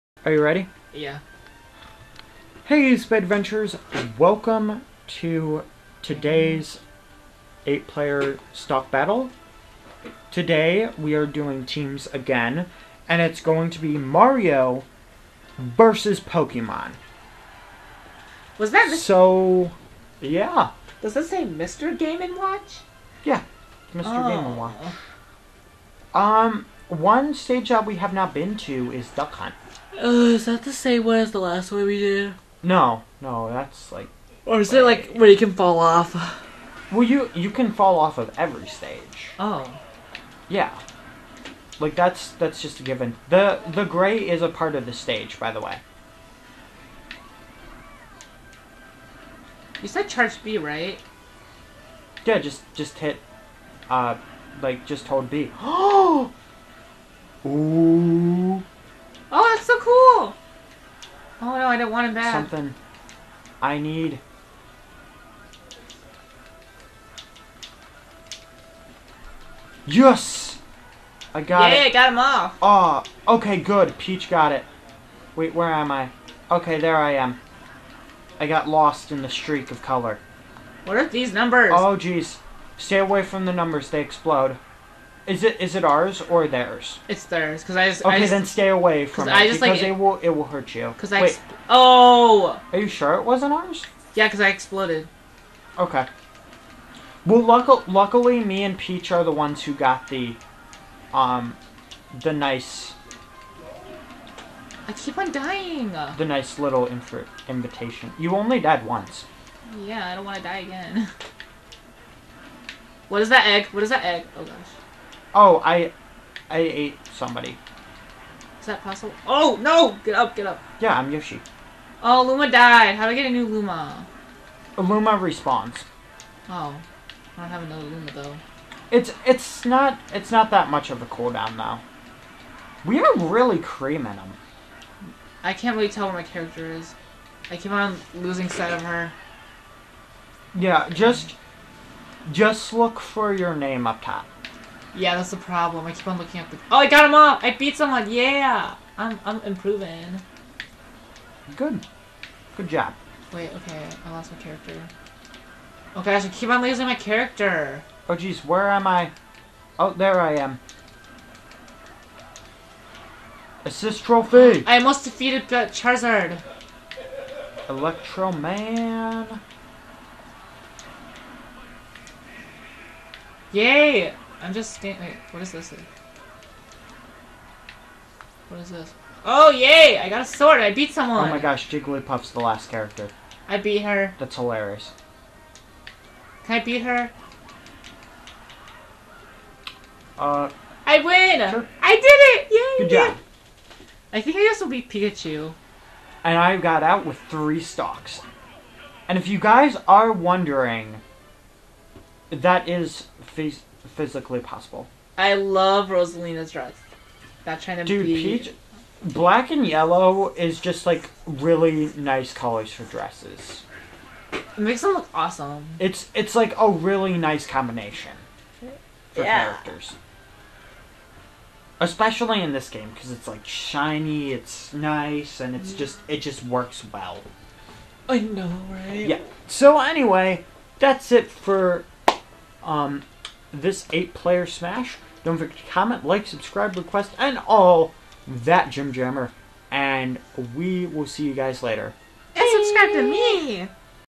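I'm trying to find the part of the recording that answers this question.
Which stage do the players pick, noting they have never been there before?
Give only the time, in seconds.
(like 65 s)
29 s.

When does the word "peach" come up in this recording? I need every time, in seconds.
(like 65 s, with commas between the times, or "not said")
73 s, 98 s, 208 s.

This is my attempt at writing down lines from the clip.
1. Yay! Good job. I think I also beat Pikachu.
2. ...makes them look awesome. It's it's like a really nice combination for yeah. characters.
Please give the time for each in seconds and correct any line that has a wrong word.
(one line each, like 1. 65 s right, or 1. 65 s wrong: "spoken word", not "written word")
1. 192 s right
2. 214 s right.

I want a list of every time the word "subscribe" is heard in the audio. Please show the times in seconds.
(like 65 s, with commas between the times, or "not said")
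236 s, 242 s.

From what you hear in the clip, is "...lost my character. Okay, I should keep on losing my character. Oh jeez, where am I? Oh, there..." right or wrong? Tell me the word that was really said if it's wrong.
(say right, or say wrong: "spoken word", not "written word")
right.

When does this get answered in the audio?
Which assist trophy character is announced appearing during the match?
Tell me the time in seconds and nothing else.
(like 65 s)
167 s.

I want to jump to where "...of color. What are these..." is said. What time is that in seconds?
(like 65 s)
79 s.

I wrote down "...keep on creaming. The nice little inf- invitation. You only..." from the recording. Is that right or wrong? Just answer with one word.
wrong.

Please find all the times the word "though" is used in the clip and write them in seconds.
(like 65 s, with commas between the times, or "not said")
128 s.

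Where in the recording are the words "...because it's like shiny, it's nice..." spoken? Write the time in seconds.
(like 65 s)
222 s.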